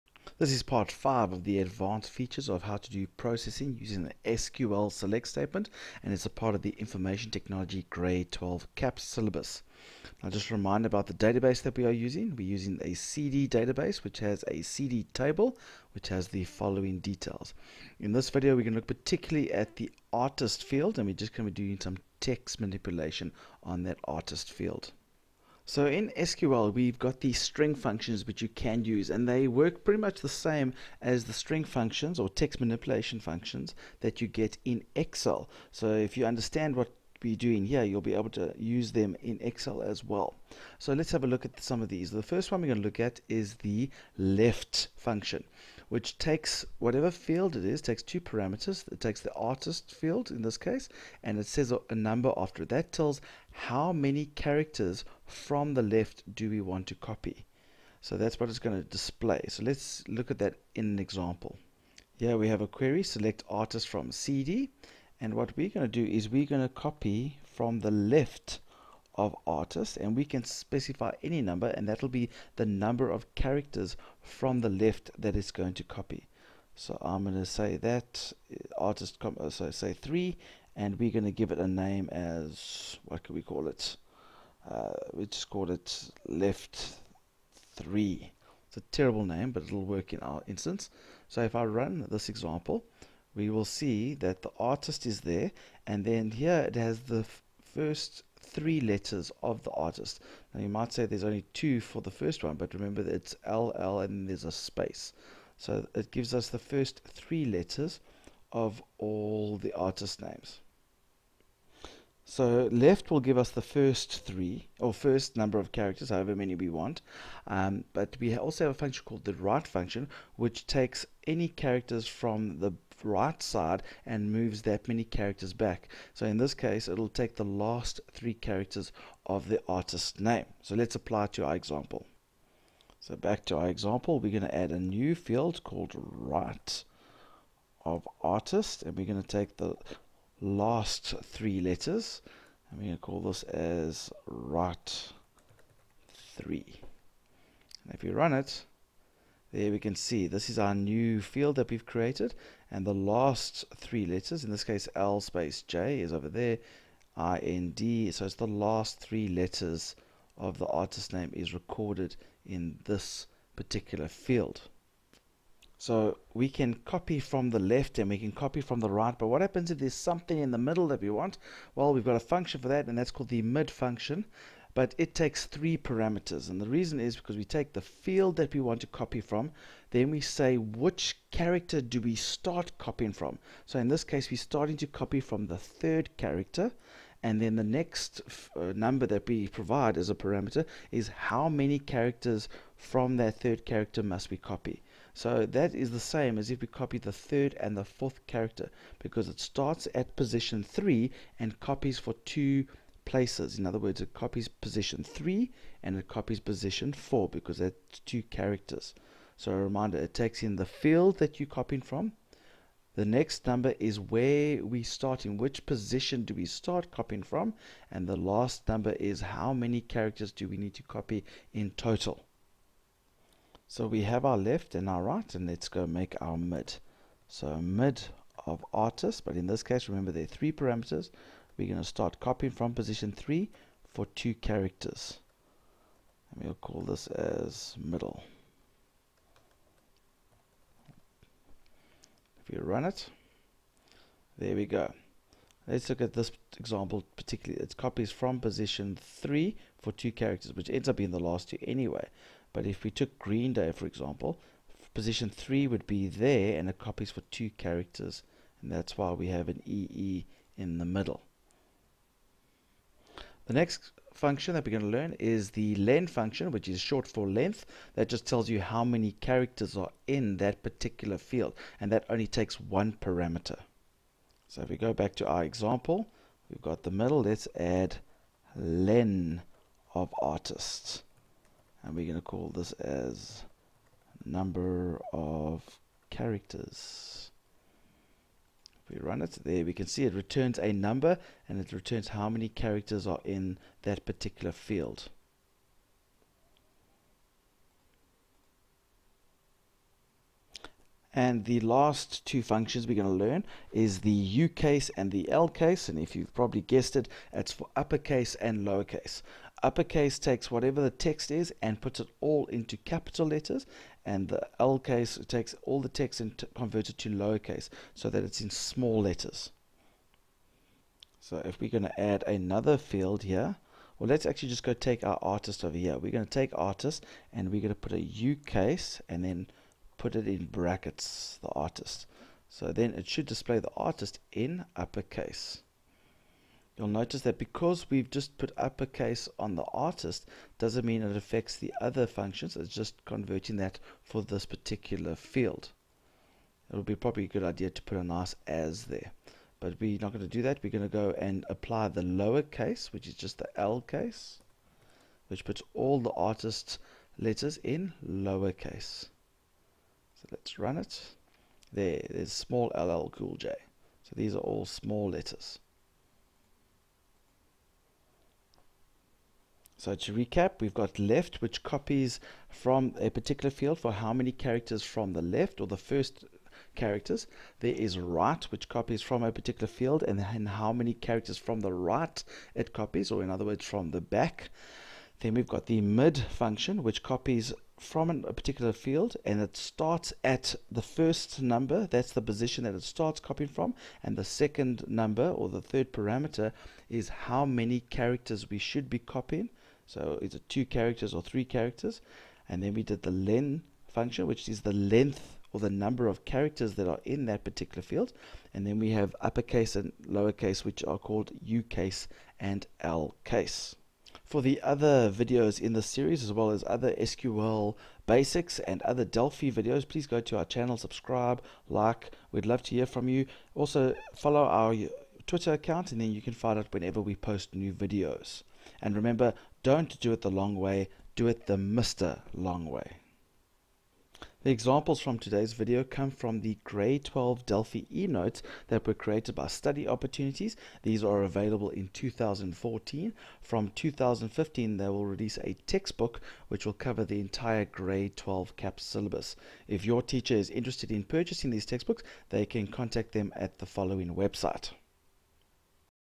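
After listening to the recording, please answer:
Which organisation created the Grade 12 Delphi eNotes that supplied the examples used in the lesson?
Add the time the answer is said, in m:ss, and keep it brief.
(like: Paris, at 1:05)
Study Opportunities, at 7:19.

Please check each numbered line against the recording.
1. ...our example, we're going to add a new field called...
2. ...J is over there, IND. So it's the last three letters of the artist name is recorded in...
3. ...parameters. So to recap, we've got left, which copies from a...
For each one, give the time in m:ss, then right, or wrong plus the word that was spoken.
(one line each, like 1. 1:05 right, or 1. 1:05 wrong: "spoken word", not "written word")
1. 2:13 right
2. 2:35 right
3. 6:05 wrong: "letters", not "parameters".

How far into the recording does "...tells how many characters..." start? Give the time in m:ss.
0:52.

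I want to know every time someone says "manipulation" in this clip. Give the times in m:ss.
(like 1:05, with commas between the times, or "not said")
0:22, 0:32.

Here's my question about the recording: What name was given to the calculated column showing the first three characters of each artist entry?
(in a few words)
left 3.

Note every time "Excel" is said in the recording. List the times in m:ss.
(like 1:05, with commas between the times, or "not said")
0:34, 0:39.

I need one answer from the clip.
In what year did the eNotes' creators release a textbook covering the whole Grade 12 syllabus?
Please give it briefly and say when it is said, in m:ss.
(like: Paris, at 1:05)
2015, at 7:23.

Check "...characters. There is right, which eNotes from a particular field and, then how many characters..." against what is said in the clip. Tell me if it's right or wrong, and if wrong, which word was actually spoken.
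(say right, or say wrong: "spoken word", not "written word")
wrong: "copies", not "eNotes".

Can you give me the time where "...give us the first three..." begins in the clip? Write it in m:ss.
1:53.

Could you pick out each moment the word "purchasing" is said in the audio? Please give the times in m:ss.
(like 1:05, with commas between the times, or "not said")
7:31.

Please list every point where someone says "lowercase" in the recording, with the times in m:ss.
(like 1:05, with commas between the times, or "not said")
5:08, 5:17, 5:52, 5:58, 6:50.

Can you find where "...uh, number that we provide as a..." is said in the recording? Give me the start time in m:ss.
3:08.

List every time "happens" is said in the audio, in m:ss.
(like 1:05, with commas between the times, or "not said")
2:49.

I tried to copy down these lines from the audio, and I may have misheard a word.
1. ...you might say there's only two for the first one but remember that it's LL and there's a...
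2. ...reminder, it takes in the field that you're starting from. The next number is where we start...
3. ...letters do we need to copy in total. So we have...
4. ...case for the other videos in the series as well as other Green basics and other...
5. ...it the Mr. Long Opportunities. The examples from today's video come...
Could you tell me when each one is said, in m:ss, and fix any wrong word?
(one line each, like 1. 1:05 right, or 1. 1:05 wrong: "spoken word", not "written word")
1. 1:40 right
2. 3:29 wrong: "copying", not "starting"
3. 3:39 wrong: "characters", not "letters"
4. 6:53 wrong: "SQL", not "Green"
5. 7:11 wrong: "Way", not "Opportunities".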